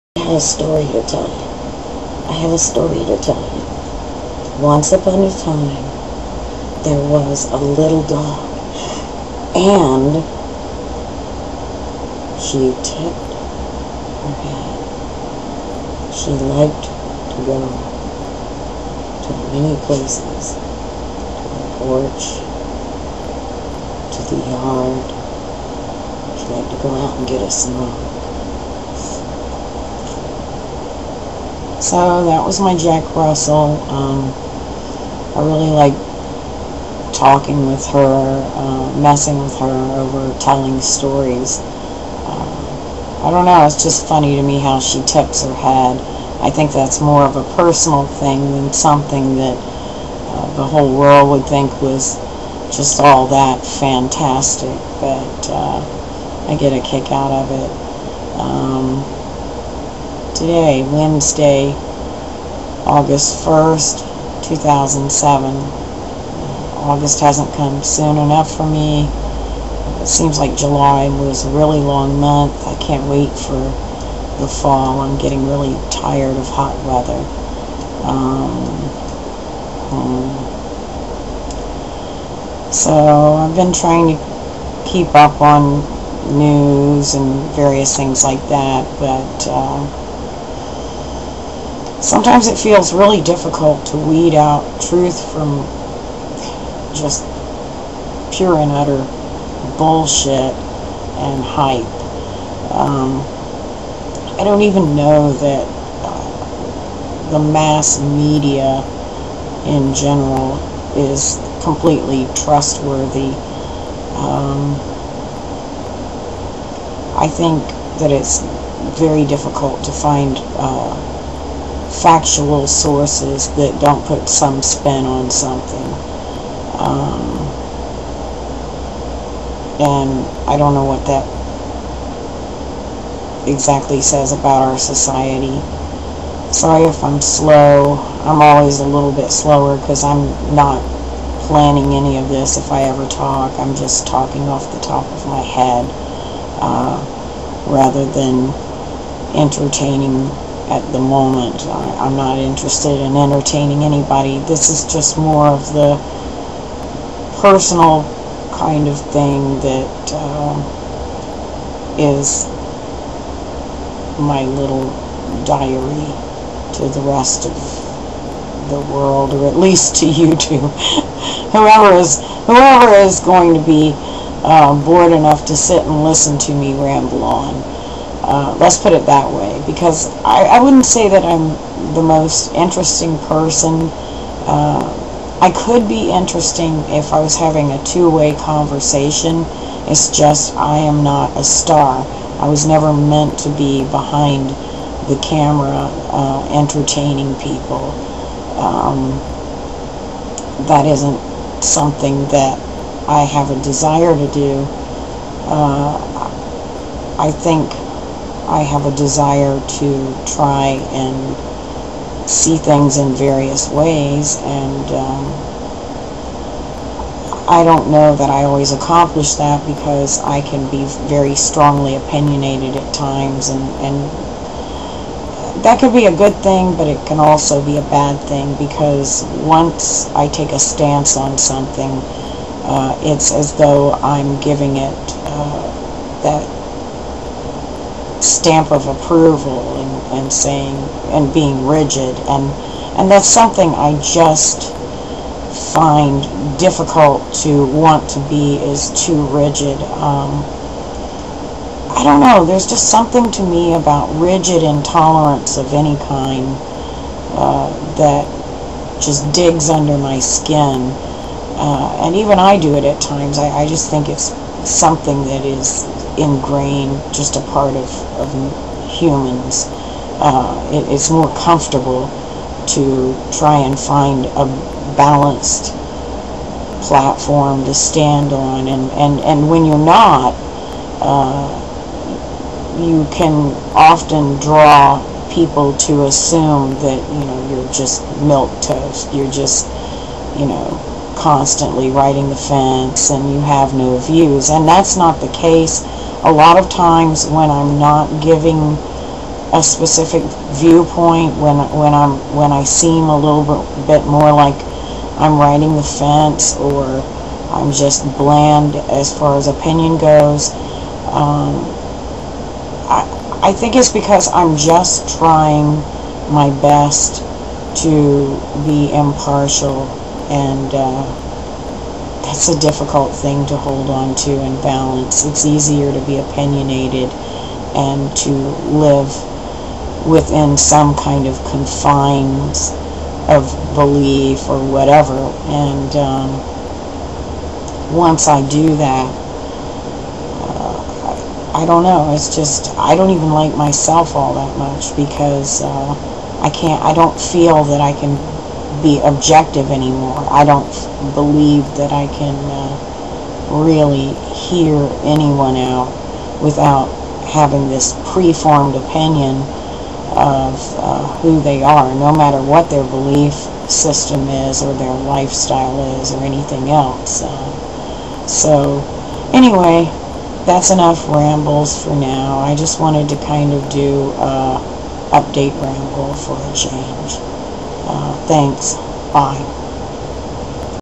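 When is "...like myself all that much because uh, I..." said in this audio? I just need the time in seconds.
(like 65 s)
343 s.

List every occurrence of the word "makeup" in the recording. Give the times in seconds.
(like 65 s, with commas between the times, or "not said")
not said.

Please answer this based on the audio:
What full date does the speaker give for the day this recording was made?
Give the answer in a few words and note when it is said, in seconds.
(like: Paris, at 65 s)
August 1st, 2007, at 62 s.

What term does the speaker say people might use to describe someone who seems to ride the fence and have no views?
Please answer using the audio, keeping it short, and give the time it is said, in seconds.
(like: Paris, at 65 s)
milk toast, at 288 s.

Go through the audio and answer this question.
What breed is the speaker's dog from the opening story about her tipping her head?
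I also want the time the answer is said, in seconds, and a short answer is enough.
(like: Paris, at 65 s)
Jack Russell, at 32 s.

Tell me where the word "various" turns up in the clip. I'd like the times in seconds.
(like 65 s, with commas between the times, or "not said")
87 s, 213 s.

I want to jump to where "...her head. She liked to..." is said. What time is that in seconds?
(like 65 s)
14 s.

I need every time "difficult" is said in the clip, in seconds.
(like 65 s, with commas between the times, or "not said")
93 s, 119 s, 246 s, 322 s.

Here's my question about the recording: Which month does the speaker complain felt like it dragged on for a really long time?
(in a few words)
July.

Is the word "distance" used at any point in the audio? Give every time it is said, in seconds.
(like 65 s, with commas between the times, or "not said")
not said.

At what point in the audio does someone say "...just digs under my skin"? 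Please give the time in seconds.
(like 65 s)
259 s.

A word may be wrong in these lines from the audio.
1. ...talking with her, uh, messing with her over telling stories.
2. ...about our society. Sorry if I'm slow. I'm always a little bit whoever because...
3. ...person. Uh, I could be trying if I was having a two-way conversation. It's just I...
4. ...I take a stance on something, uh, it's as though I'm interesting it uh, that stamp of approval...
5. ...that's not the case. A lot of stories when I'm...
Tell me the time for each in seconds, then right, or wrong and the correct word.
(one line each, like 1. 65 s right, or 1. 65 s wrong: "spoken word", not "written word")
1. 37 s right
2. 134 s wrong: "slower", not "whoever"
3. 183 s wrong: "interesting", not "trying"
4. 230 s wrong: "giving", not "interesting"
5. 294 s wrong: "times", not "stories".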